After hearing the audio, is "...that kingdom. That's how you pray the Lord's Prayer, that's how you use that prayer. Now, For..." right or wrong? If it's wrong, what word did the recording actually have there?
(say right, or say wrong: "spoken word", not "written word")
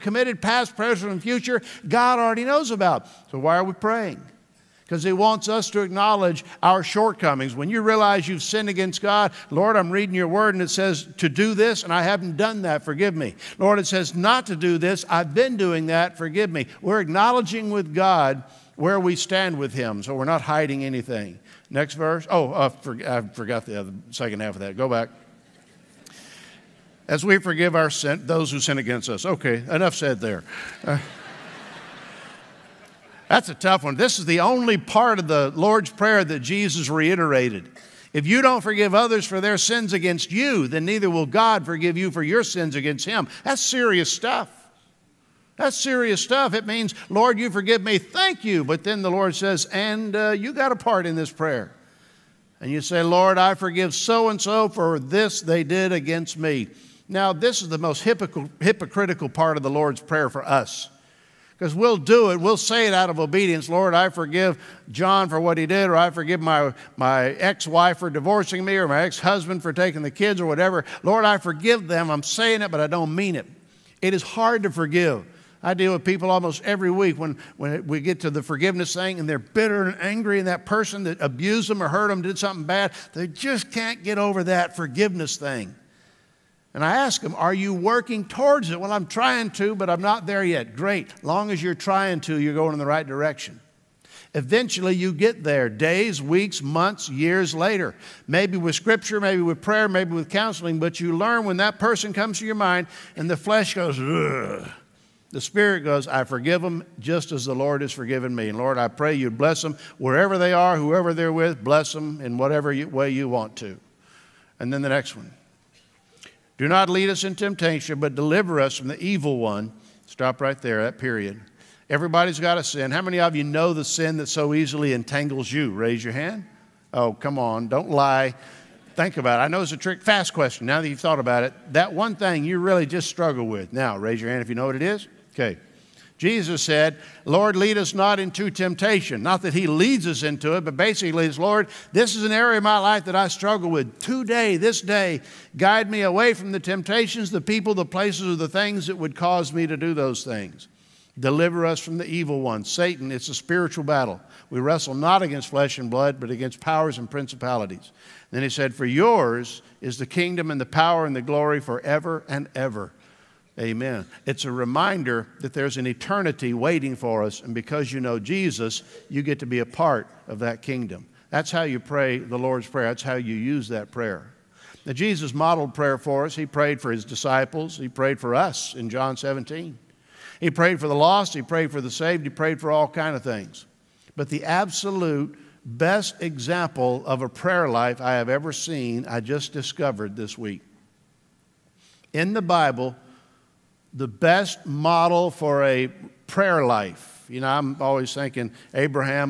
wrong: "Jesus", not "For".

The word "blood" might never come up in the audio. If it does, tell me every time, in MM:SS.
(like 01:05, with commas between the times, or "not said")
02:35.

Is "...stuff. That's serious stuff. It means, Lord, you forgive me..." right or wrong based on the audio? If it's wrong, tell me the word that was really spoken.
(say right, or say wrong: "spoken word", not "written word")
right.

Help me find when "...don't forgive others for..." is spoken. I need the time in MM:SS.
00:38.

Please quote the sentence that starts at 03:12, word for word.
In the Bible, the best model for a prayer life.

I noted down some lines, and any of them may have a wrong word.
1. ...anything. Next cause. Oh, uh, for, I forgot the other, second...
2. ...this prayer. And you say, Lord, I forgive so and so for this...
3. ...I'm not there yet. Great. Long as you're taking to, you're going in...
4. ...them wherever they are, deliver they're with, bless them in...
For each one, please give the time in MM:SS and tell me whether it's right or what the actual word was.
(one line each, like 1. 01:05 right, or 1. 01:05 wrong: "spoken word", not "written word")
1. 00:20 wrong: "verse", not "cause"
2. 00:51 right
3. 01:29 wrong: "trying", not "taking"
4. 01:49 wrong: "whoever", not "deliver".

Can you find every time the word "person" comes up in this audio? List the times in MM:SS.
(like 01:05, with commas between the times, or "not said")
01:20, 01:41.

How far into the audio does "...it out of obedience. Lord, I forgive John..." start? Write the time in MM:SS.
01:02.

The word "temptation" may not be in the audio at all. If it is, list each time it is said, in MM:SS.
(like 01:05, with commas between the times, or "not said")
01:57, 02:18, 02:26.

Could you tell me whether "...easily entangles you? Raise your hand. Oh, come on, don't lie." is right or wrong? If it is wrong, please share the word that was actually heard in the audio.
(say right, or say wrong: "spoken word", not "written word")
right.